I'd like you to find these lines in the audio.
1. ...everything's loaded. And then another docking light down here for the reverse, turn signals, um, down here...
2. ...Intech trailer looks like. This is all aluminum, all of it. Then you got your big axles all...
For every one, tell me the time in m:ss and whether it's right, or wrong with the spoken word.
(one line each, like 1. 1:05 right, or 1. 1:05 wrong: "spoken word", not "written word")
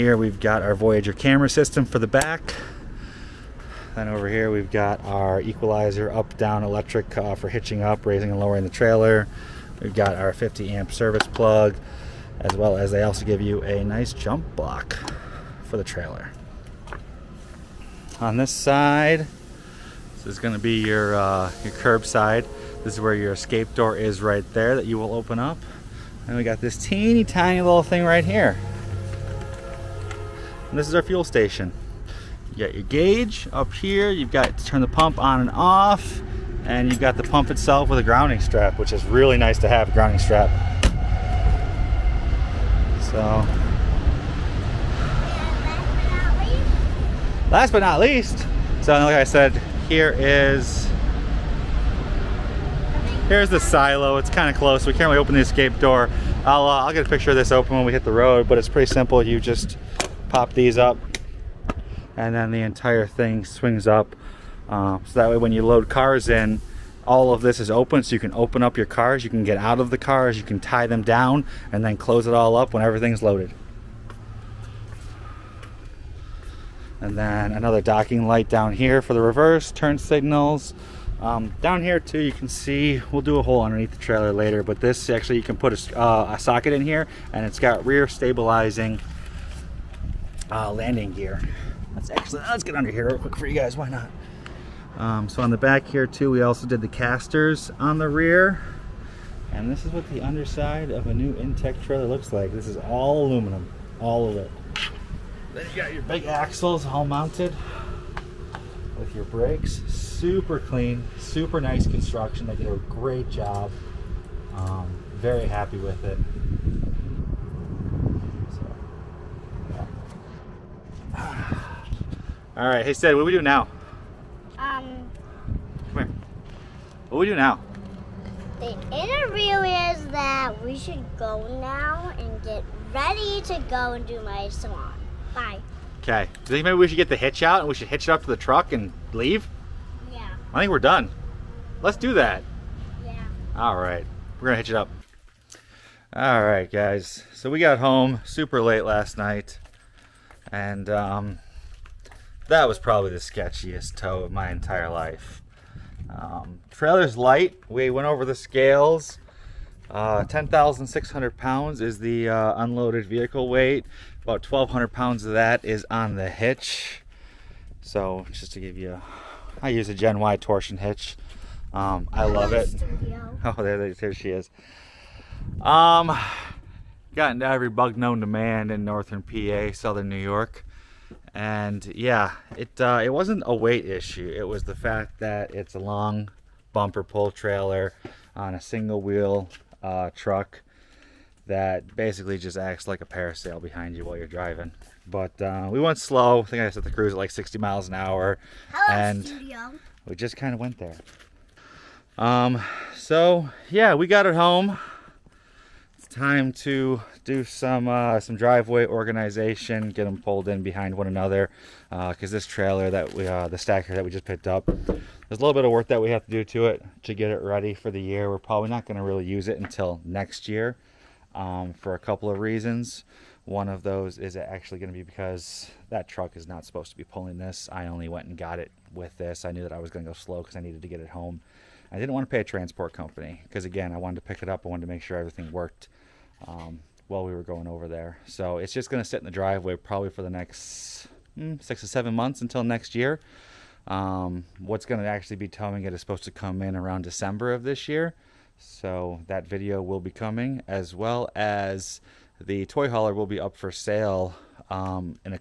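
1. 1:12 right
2. 1:41 right.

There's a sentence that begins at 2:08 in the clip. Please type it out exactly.
The interview is that we should go now and get ready to go and do my salon.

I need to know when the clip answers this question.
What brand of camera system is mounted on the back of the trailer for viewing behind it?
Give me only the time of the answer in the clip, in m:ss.
0:00.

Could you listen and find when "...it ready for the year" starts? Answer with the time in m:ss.
3:37.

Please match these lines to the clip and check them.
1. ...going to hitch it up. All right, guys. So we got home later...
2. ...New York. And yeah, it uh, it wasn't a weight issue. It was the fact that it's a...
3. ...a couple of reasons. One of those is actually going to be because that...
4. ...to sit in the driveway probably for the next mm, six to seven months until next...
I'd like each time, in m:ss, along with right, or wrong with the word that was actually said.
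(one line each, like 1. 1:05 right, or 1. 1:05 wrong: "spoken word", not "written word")
1. 2:24 wrong: "super", not "later"
2. 3:00 right
3. 3:41 right
4. 3:59 right.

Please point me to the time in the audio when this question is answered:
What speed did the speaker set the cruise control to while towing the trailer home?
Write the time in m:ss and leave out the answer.
3:17.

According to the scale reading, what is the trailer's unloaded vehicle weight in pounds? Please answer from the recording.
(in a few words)
10,600 pounds.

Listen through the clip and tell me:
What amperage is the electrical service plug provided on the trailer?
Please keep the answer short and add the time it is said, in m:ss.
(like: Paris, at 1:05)
50 amp, at 0:10.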